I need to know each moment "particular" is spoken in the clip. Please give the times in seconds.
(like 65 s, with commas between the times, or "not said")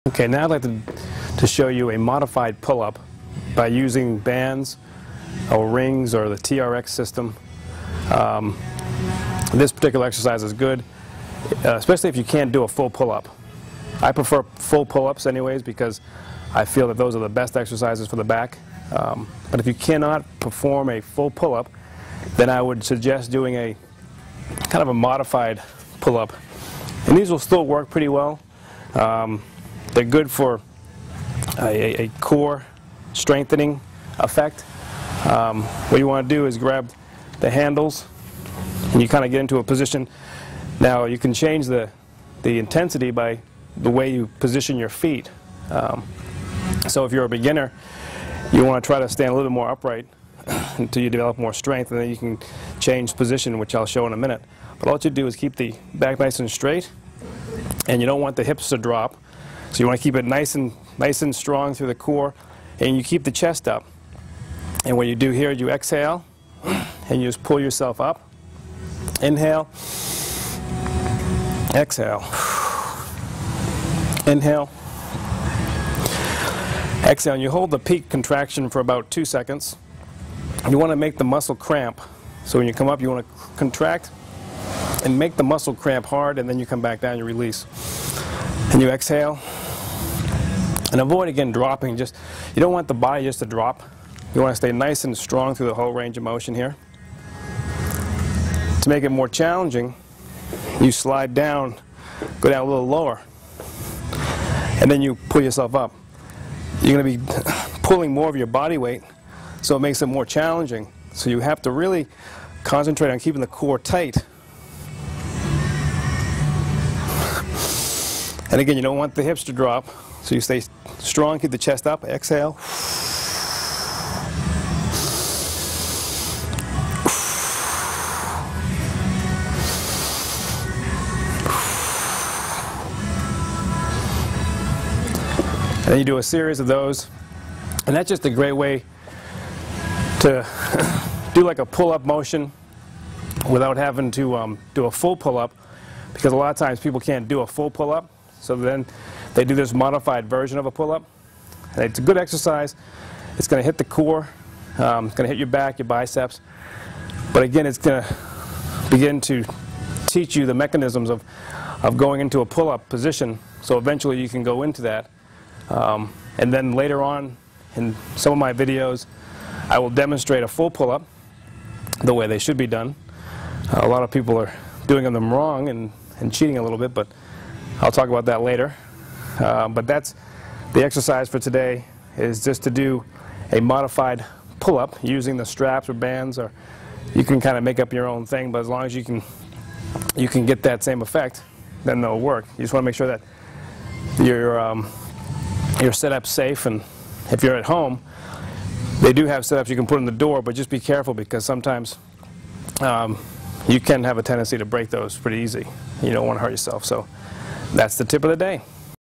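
9 s.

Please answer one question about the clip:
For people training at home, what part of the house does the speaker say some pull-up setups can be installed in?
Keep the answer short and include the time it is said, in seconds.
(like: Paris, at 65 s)
The door, at 200 s.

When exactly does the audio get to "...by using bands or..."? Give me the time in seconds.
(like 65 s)
3 s.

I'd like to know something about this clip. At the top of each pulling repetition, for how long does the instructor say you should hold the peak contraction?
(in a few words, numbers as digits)
2 seconds.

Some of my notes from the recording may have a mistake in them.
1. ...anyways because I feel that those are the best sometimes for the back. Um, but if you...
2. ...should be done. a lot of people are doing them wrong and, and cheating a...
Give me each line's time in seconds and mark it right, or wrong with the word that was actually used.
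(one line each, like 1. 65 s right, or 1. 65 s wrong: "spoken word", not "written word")
1. 15 s wrong: "exercises", not "sometimes"
2. 172 s right.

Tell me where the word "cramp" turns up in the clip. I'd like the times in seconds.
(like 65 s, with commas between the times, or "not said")
81 s, 85 s.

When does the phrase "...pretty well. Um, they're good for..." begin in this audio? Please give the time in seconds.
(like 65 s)
27 s.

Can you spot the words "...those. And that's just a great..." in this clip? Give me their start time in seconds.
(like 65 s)
136 s.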